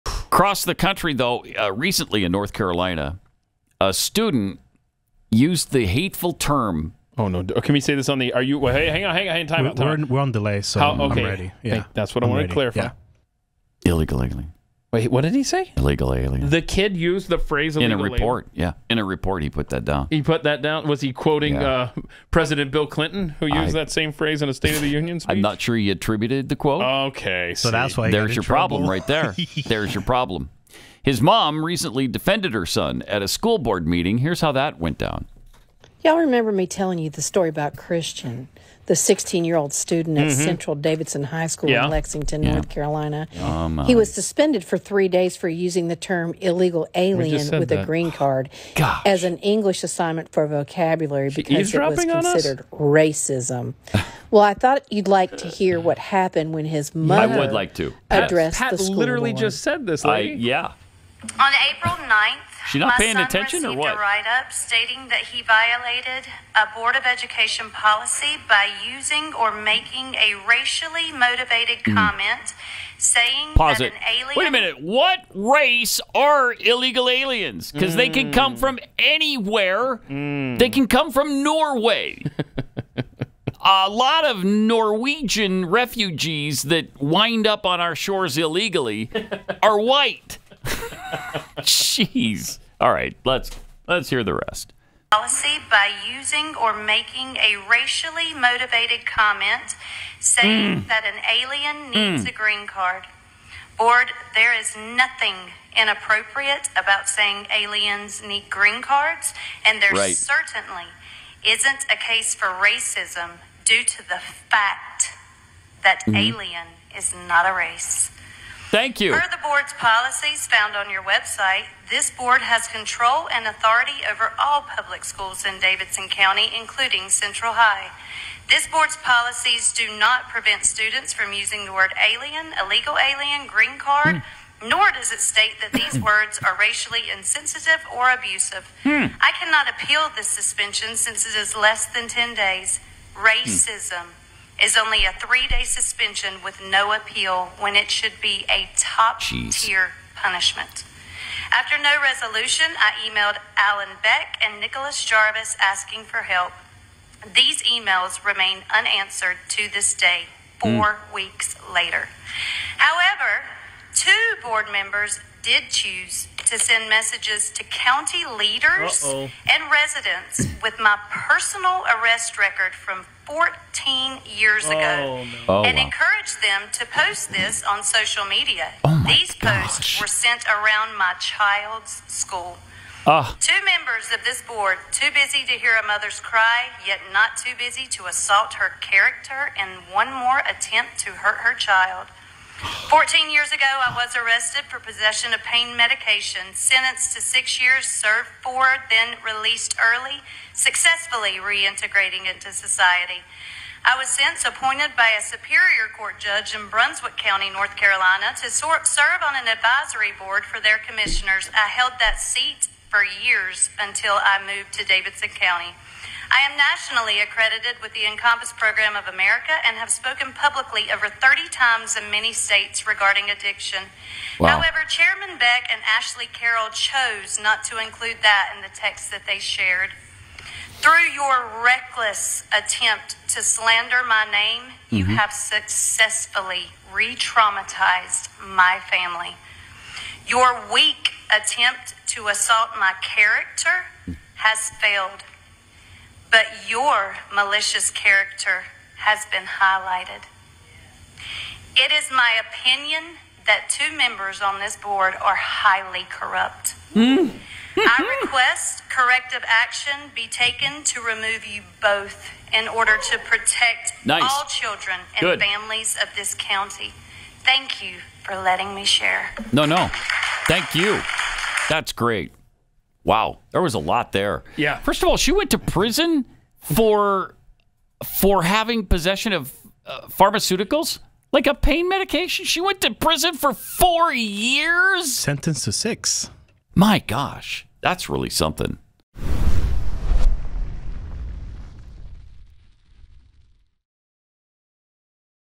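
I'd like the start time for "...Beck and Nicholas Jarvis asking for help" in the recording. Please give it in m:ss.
2:34.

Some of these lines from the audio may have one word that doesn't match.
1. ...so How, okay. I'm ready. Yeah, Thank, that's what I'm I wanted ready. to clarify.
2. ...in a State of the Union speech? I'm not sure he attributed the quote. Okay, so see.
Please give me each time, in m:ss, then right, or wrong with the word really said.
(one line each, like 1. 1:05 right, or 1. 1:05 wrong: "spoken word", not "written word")
1. 0:10 right
2. 0:24 right.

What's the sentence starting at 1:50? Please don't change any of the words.
certainly isn't a case for racism due to the fact that mm-hmm.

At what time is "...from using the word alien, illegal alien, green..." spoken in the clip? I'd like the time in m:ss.
2:11.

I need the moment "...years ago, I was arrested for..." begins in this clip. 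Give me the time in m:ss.
3:13.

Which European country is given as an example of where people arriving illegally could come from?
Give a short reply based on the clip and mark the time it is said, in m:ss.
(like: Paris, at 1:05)
Norway, at 1:21.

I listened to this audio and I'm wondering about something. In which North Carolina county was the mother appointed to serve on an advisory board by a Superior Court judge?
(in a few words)
Brunswick County.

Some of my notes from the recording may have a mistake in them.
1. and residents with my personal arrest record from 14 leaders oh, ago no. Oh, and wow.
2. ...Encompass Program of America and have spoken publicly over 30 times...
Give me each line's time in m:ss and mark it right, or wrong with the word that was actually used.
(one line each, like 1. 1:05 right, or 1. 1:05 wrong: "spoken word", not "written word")
1. 2:49 wrong: "years", not "leaders"
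2. 3:38 right.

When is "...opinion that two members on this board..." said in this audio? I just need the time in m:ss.
4:12.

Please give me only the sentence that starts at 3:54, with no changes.
you have successfully re traumatized my family.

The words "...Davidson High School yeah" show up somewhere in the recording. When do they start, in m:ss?
0:40.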